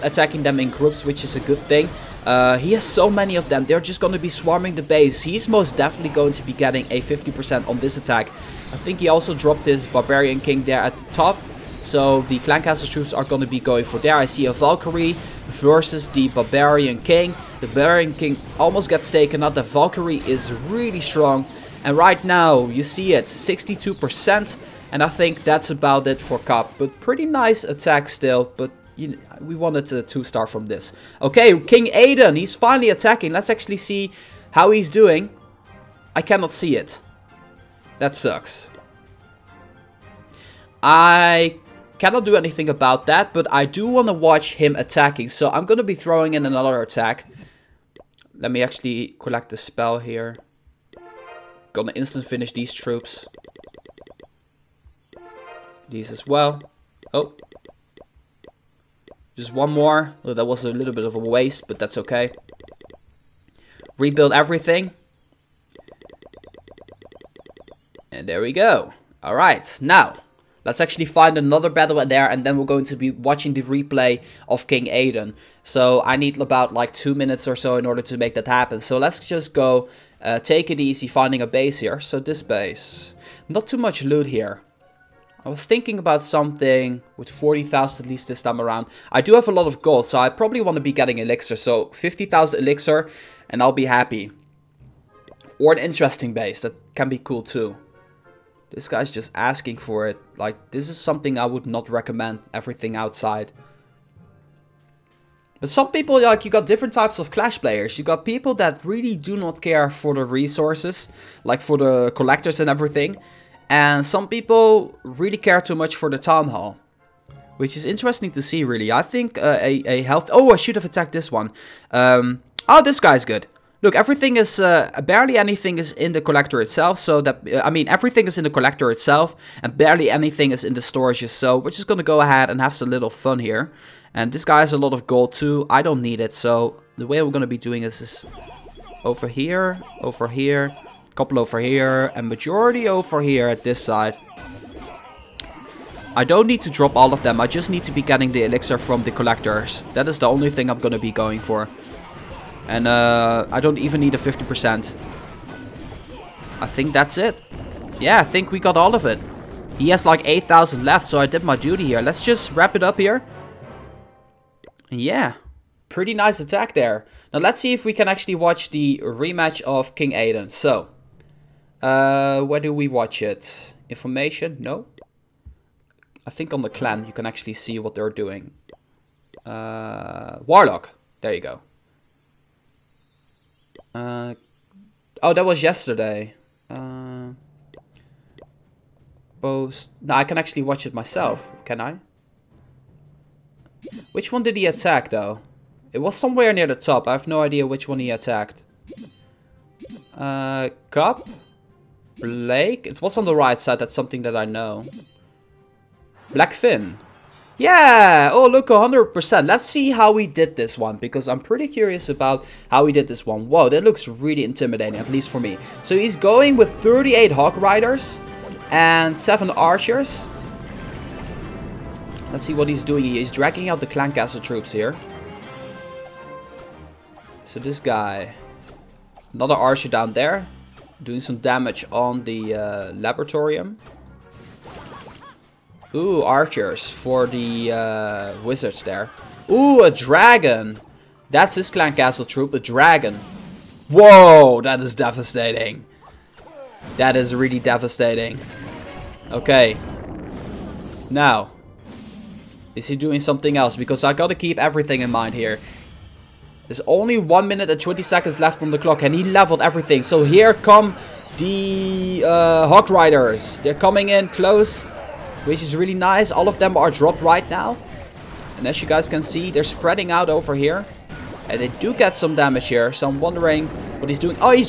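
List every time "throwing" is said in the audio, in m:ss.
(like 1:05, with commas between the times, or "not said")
0:45.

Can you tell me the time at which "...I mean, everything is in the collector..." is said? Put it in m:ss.
2:07.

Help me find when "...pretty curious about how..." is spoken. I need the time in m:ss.
3:31.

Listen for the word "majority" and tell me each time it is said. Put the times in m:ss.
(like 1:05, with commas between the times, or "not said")
2:22.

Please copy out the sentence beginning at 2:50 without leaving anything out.
So, uh, where do we watch it?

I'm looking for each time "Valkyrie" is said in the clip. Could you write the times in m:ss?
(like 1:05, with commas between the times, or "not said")
0:14, 0:19.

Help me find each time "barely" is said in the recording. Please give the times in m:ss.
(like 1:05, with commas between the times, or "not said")
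2:05, 2:09.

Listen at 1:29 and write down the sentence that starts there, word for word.
I do have a lot of gold, so I probably want to be getting elixir.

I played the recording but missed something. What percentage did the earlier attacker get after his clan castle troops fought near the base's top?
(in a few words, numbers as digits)
62%.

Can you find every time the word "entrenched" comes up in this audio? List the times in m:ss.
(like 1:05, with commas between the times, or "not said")
not said.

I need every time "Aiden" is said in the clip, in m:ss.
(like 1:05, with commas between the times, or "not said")
0:31, 1:14, 2:50.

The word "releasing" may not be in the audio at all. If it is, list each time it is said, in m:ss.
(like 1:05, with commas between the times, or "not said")
not said.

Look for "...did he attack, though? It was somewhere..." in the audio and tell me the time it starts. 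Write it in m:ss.
3:14.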